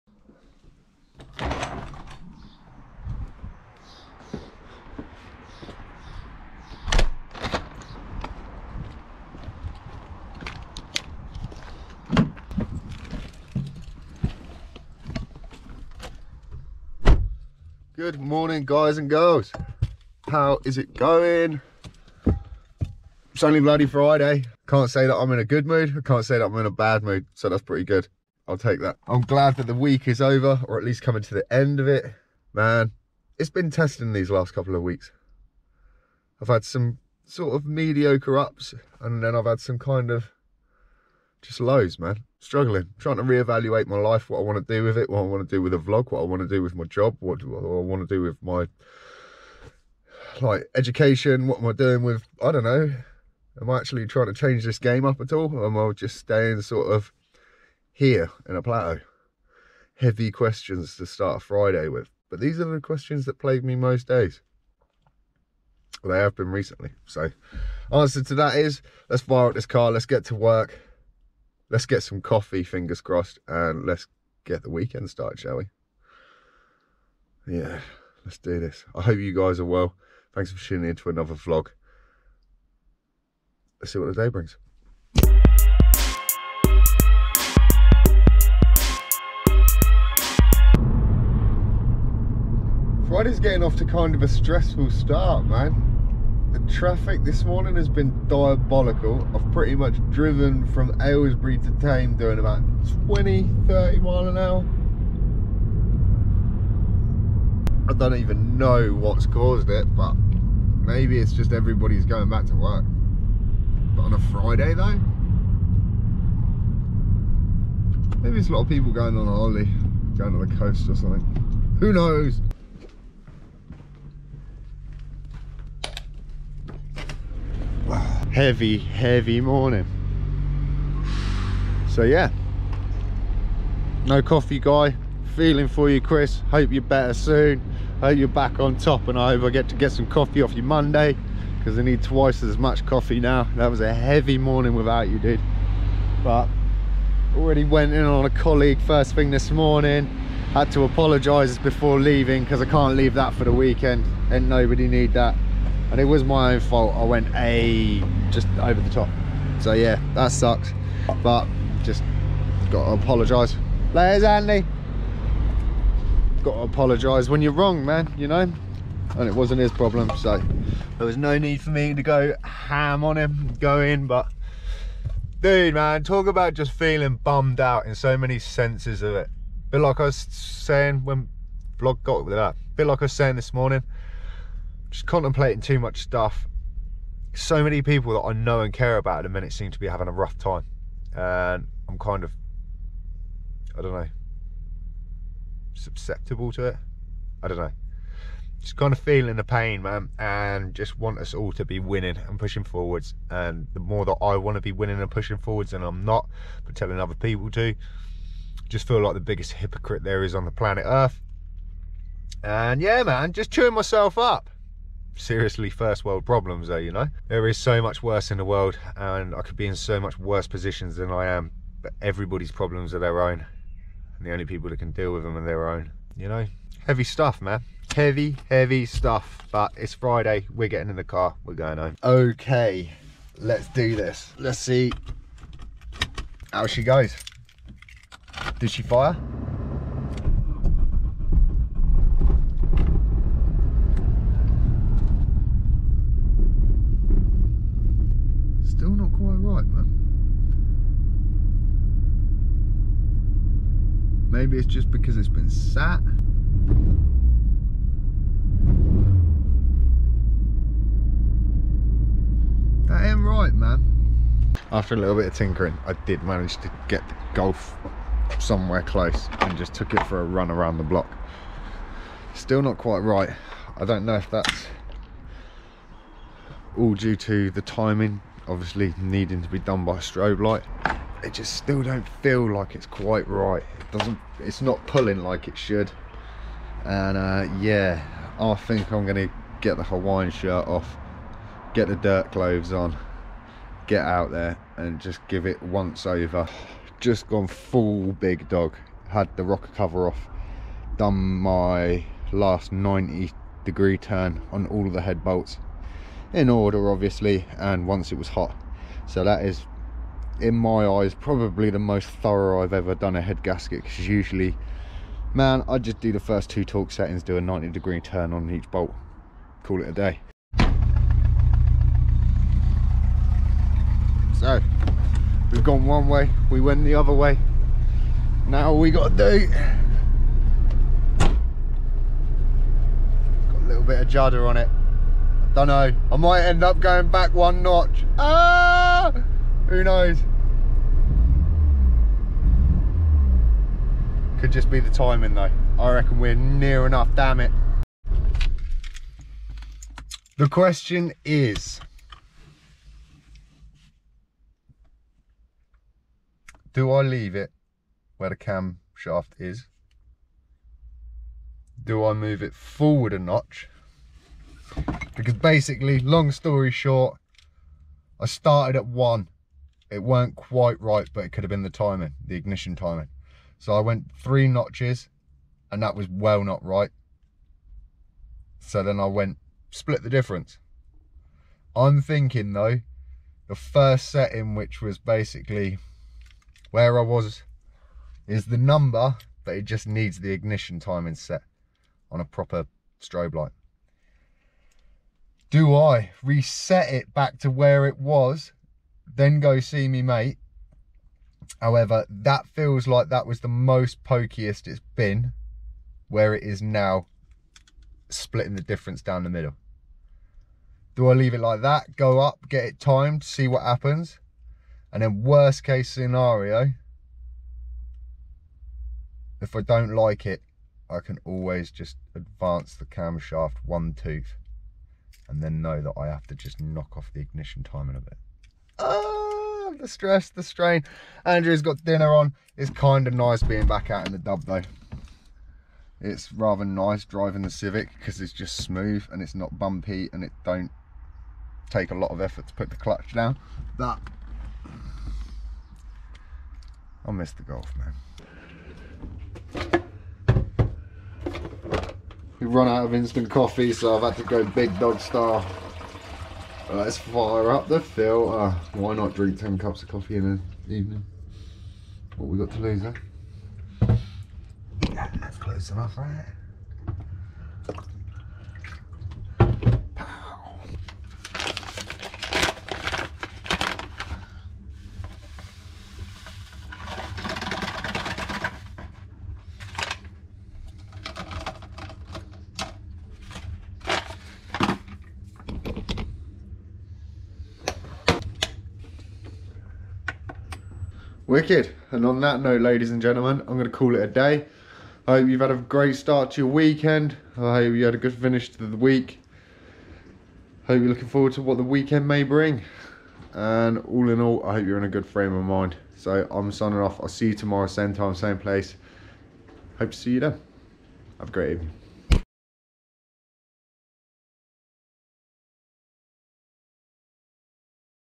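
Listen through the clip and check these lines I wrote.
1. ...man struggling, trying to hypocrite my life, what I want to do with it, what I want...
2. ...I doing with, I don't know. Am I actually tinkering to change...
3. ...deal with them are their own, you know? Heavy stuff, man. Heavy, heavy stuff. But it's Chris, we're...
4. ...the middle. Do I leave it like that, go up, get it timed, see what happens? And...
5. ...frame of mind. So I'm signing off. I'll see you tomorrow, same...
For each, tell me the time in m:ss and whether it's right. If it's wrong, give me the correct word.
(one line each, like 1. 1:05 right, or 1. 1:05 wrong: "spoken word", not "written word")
1. 0:41 wrong: "reevaluate", not "hypocrite"
2. 0:51 wrong: "trying", not "tinkering"
3. 3:44 wrong: "Friday", not "Chris"
4. 6:49 right
5. 8:25 right.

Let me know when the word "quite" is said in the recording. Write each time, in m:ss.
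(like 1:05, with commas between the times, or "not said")
4:32, 4:42, 6:10.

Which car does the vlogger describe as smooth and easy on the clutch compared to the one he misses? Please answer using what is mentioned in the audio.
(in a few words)
Civic.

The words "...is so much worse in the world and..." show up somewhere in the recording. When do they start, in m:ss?
3:37.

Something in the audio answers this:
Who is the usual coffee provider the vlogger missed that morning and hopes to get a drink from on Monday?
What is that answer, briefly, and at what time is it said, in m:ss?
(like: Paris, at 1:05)
Chris, at 2:15.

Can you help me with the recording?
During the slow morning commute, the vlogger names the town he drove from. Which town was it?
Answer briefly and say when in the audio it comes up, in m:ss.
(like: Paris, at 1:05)
Aylesbury, at 1:41.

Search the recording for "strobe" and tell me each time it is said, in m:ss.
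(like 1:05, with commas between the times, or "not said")
4:39, 6:32.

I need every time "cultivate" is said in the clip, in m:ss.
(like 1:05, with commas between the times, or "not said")
not said.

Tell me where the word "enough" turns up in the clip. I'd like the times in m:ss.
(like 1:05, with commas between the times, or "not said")
5:46, 7:45.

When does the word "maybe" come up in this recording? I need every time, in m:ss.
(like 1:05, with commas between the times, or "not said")
1:50, 1:58, 4:14.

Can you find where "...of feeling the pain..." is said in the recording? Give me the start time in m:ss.
3:18.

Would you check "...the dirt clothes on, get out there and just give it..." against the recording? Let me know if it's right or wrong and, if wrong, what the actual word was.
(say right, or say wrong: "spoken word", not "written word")
right.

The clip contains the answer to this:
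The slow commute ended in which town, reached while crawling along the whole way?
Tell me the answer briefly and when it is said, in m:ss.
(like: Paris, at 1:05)
Thame, at 1:41.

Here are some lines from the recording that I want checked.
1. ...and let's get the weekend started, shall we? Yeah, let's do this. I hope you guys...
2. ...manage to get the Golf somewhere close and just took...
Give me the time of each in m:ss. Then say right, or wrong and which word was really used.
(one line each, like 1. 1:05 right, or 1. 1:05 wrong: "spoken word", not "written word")
1. 1:13 right
2. 4:26 right.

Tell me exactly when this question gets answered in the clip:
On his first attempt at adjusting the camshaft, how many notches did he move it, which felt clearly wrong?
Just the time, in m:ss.
6:14.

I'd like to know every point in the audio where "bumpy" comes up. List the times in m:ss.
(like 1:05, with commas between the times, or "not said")
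7:19.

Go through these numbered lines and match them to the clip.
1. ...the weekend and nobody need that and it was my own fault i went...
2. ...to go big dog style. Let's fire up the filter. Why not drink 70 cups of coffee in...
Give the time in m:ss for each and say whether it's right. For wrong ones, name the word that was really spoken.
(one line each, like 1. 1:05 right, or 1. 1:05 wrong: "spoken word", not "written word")
1. 2:33 right
2. 7:34 wrong: "10", not "70".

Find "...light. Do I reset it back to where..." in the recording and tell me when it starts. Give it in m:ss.
6:33.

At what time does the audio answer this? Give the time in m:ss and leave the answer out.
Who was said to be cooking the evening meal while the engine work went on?
7:11.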